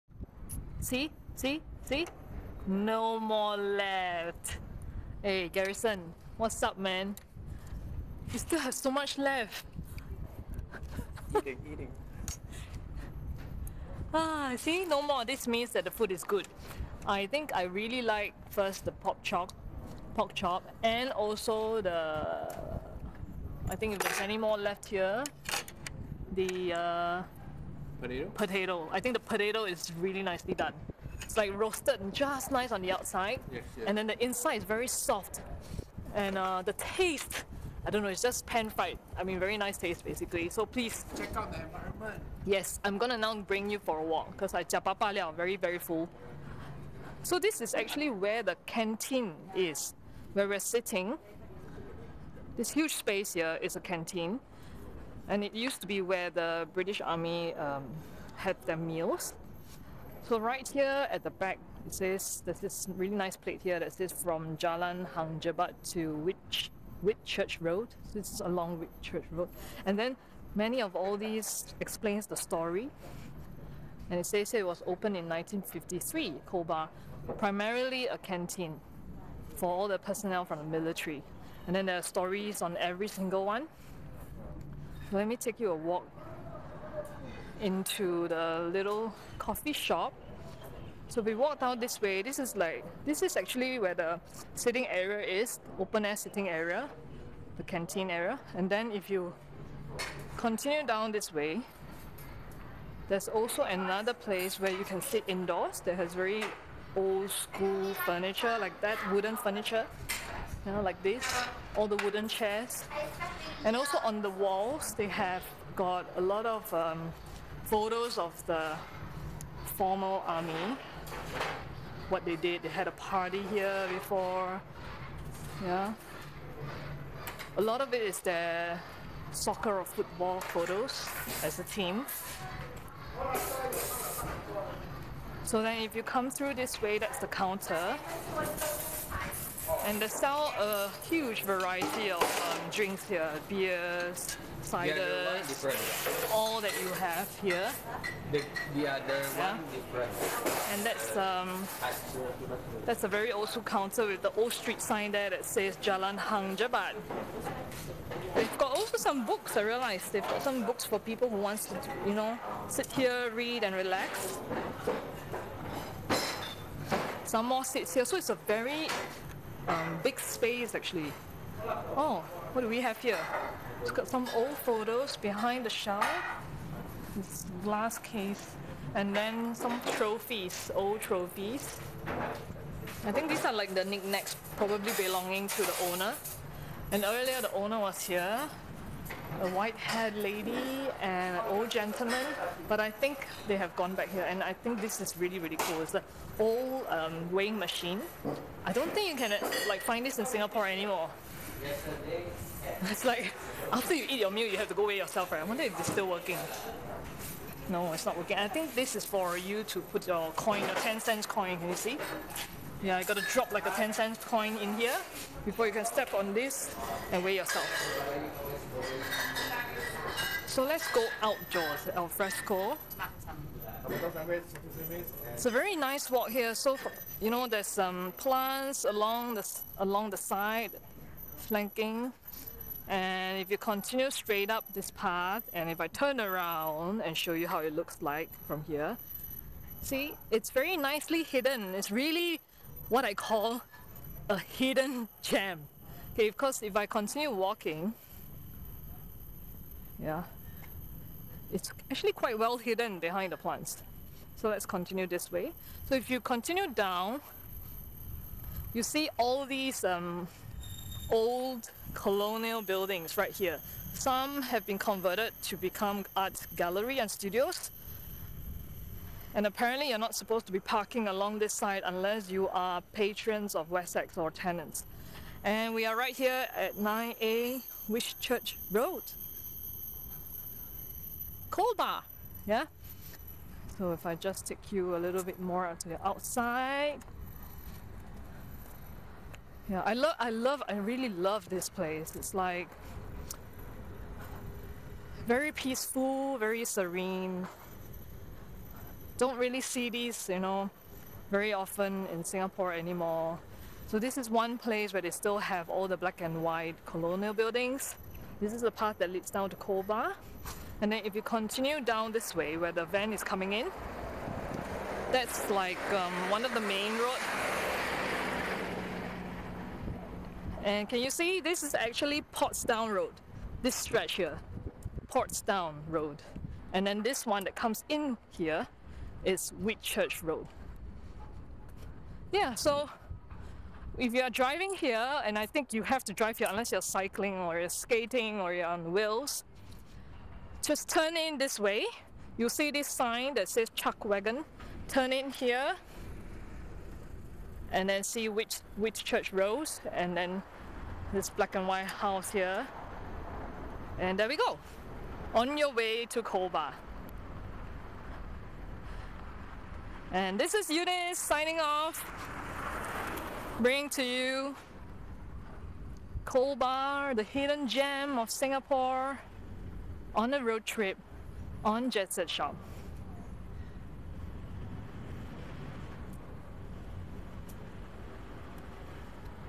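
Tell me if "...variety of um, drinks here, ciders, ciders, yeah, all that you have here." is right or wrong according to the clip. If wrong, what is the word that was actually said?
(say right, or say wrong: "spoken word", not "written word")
wrong: "beers", not "ciders".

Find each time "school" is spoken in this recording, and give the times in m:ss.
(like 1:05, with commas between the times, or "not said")
1:47, 2:33.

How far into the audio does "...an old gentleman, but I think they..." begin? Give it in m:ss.
3:11.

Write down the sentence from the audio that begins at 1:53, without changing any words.
And also on the walls, they have got a lot of um, photos of the former army, what they did.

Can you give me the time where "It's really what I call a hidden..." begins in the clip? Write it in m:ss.
4:01.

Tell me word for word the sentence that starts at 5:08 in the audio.
This is the path that leads down to Colbar.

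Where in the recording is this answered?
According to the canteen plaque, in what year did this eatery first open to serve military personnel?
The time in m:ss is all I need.
1:15.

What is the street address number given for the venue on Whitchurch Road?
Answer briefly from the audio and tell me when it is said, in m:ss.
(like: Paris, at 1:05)
9A, at 4:36.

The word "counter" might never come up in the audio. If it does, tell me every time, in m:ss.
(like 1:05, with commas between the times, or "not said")
2:17, 2:33.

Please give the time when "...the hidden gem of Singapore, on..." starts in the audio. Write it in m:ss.
6:07.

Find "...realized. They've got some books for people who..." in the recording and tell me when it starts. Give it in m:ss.
2:39.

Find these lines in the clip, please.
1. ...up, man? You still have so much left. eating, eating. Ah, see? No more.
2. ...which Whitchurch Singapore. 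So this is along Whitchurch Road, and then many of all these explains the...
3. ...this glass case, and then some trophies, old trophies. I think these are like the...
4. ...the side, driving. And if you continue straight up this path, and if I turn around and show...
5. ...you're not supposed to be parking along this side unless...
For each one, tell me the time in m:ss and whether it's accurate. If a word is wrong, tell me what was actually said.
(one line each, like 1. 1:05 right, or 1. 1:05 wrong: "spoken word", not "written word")
1. 0:06 right
2. 1:06 wrong: "Road", not "Singapore"
3. 2:57 right
4. 3:50 wrong: "flanking", not "driving"
5. 4:29 right.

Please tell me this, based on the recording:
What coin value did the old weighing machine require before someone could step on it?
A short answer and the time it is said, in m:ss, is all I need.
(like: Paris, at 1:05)
10 cents, at 3:30.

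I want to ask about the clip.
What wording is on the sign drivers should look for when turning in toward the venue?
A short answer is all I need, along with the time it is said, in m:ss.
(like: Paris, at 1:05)
Chuck Wagon, at 5:43.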